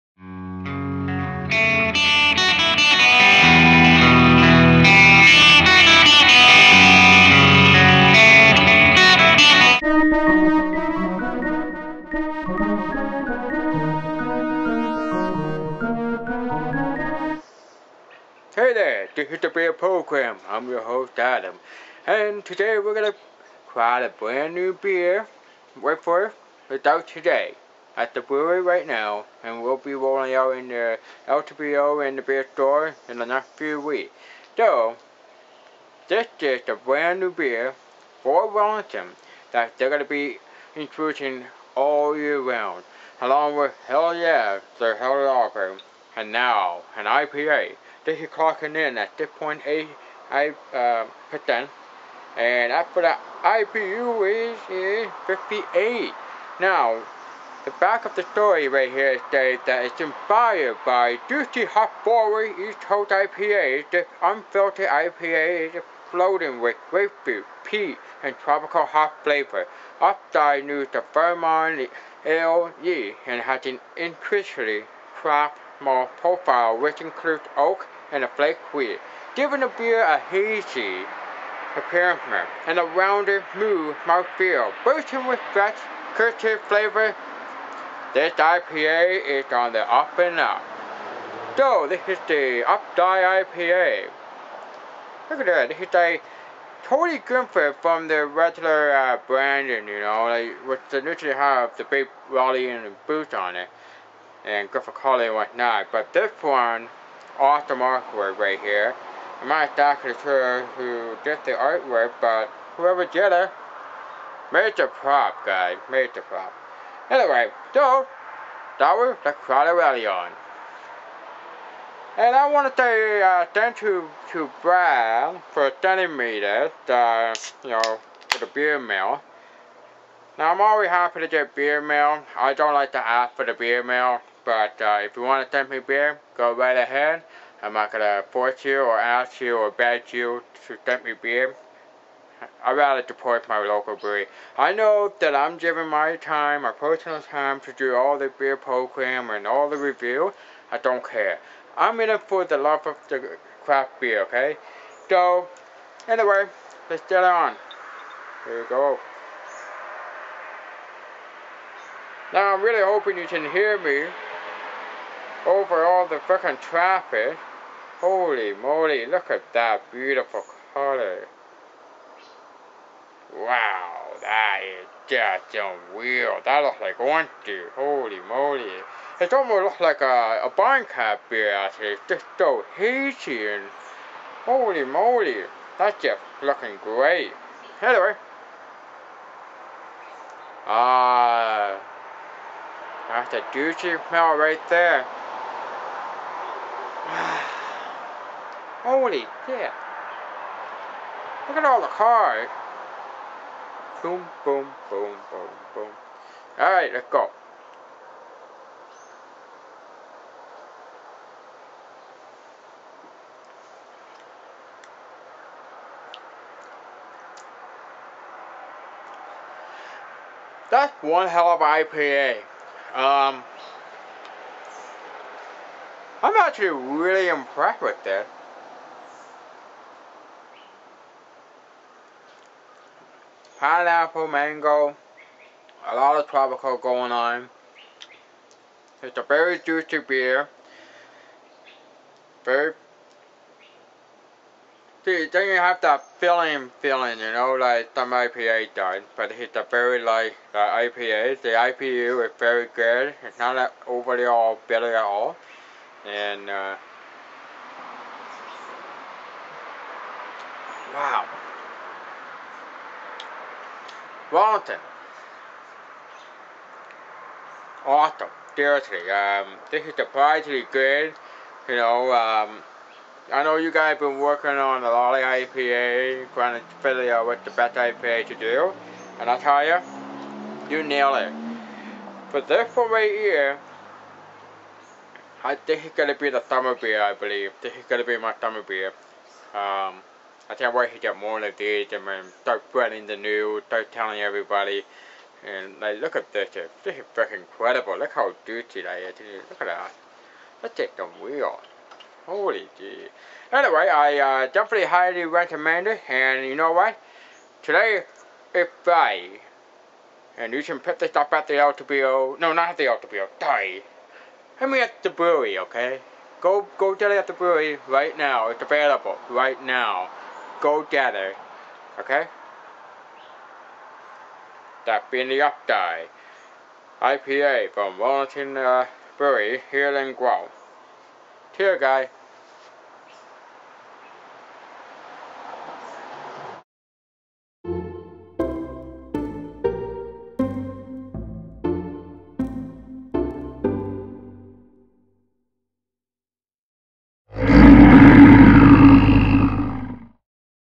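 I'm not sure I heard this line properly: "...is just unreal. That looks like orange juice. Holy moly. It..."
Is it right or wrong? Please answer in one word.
right.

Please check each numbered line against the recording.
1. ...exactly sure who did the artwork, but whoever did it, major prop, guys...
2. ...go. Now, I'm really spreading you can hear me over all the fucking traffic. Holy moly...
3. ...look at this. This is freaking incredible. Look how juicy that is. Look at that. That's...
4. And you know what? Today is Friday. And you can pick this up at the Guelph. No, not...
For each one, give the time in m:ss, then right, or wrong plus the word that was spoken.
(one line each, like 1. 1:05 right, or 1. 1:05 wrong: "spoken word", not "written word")
1. 1:49 right
2. 2:38 wrong: "hoping", not "spreading"
3. 4:55 right
4. 5:06 wrong: "LCBO", not "Guelph".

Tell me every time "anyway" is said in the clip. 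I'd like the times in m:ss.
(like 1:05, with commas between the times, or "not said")
1:57, 2:36, 3:07, 5:03.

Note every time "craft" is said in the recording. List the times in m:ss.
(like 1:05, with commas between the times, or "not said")
1:15, 2:33.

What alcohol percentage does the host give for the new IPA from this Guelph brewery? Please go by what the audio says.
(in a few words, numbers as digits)
6.8%.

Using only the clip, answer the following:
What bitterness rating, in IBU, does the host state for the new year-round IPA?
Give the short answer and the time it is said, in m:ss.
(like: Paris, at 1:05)
58, at 0:55.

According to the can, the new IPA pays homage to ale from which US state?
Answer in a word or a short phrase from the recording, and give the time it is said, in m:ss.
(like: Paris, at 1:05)
Vermont, at 1:11.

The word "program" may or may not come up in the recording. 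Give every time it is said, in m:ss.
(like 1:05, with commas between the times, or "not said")
0:19, 2:28.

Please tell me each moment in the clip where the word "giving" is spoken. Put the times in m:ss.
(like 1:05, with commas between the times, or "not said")
1:19, 2:25.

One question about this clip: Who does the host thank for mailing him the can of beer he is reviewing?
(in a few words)
Brad.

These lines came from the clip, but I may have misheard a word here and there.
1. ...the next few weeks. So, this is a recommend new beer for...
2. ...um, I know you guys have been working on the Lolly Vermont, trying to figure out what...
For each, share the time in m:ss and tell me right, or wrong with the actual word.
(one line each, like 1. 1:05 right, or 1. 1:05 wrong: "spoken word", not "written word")
1. 0:33 wrong: "brand", not "recommend"
2. 4:32 wrong: "IPA", not "Vermont".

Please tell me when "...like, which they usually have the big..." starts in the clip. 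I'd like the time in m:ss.
1:40.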